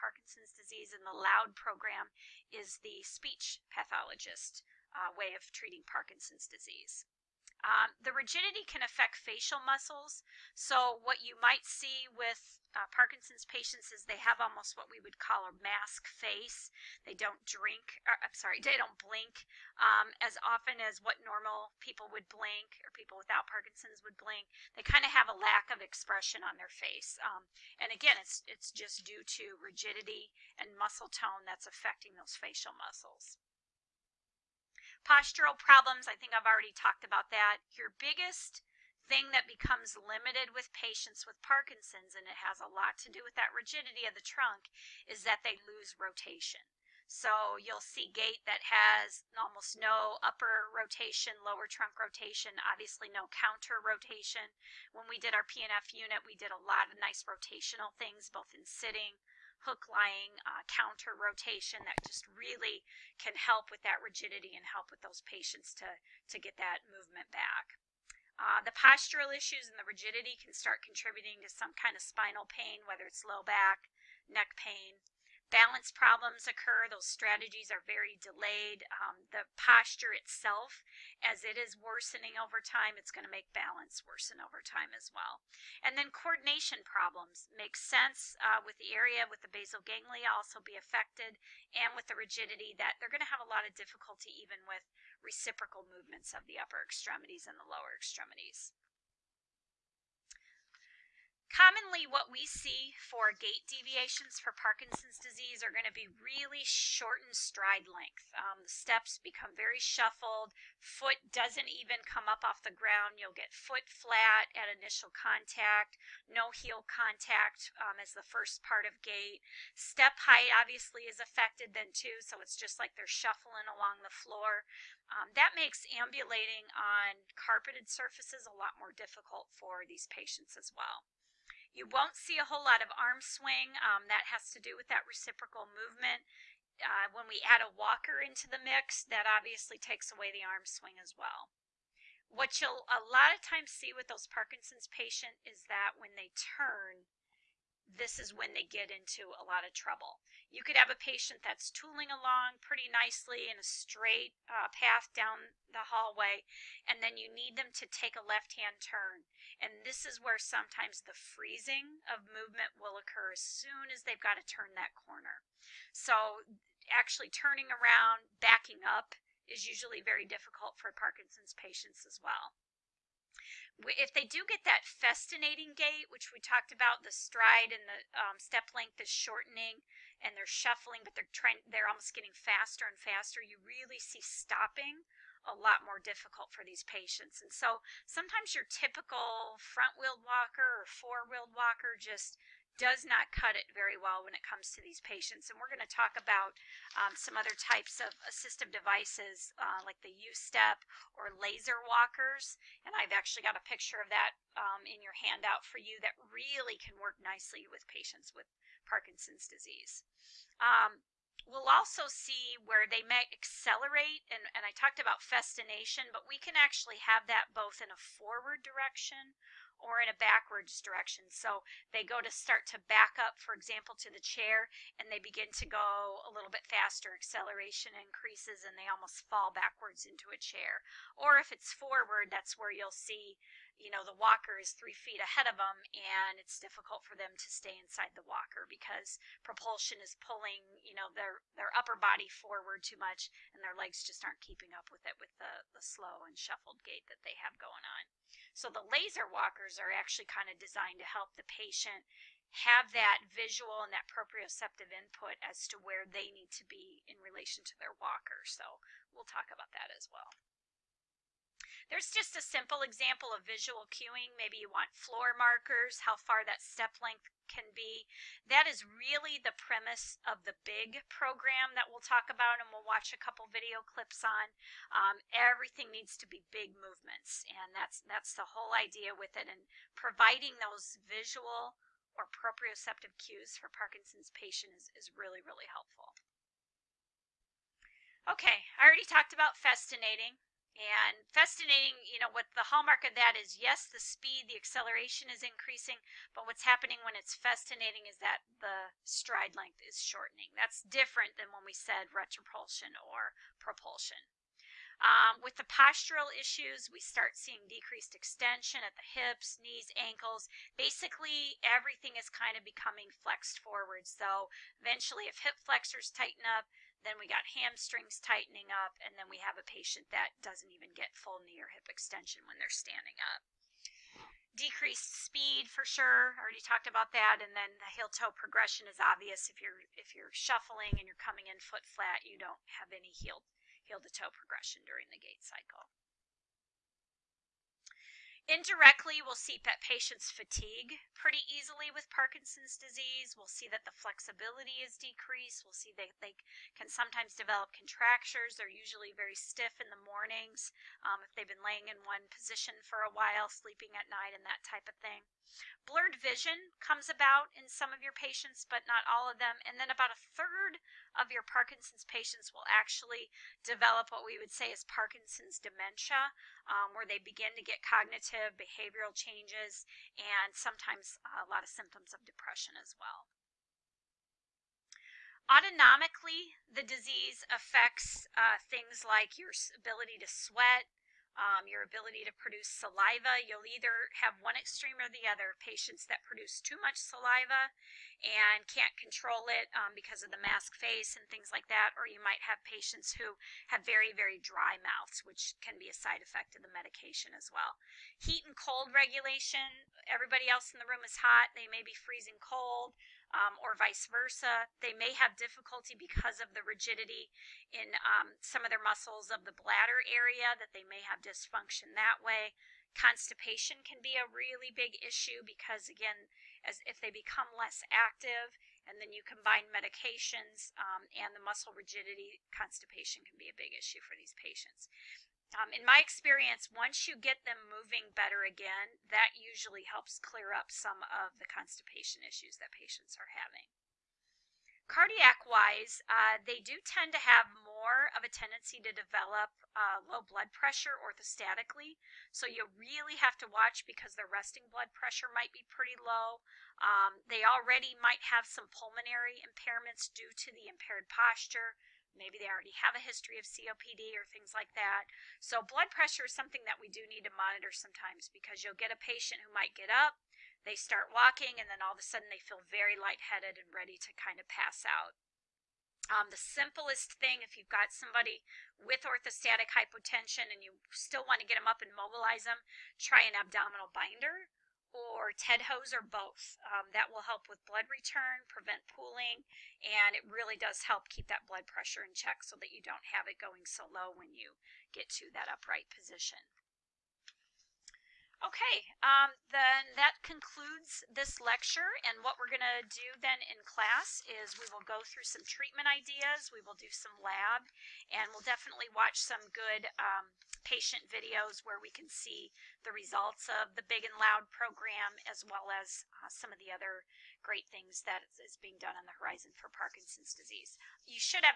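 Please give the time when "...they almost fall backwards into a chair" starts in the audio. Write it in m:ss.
3:48.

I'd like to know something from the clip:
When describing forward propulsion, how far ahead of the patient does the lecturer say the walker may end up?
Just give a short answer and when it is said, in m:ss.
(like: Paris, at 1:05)
3 feet, at 3:54.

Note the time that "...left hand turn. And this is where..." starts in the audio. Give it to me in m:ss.
2:38.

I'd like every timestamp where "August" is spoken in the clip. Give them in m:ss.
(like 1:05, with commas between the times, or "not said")
not said.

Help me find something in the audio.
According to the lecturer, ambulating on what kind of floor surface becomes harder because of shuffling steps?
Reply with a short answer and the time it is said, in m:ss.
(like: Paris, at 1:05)
carpeted surfaces, at 2:07.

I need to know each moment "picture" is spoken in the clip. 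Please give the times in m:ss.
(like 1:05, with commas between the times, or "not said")
3:23.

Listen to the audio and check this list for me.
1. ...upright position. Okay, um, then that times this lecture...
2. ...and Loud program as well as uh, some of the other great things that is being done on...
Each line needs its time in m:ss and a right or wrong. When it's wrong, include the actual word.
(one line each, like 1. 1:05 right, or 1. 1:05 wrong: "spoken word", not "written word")
1. 8:05 wrong: "concludes", not "times"
2. 8:24 right.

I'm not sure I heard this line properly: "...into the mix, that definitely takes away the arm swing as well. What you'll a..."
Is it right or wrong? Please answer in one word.
wrong.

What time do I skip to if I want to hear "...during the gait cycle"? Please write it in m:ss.
5:34.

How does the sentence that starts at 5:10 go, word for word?
Basically, everything is kind of becoming flexed forward.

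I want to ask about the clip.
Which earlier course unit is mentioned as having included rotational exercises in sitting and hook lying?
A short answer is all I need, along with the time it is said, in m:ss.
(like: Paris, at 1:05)
PNF unit, at 0:55.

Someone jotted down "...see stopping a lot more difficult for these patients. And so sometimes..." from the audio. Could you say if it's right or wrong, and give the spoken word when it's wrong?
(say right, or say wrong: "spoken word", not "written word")
right.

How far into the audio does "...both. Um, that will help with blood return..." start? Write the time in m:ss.
7:56.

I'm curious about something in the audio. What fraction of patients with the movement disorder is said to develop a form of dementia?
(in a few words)
a third.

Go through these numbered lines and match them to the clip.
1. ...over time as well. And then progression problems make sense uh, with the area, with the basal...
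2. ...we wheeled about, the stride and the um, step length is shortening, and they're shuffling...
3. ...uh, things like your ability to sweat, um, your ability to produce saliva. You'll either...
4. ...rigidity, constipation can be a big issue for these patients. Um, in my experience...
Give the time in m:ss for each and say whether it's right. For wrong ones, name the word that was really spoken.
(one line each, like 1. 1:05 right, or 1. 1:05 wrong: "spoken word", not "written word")
1. 1:24 wrong: "coordination", not "progression"
2. 2:56 wrong: "talked", not "wheeled"
3. 6:18 right
4. 7:01 right.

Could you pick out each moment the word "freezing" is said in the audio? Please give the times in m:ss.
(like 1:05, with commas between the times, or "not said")
2:41, 6:41.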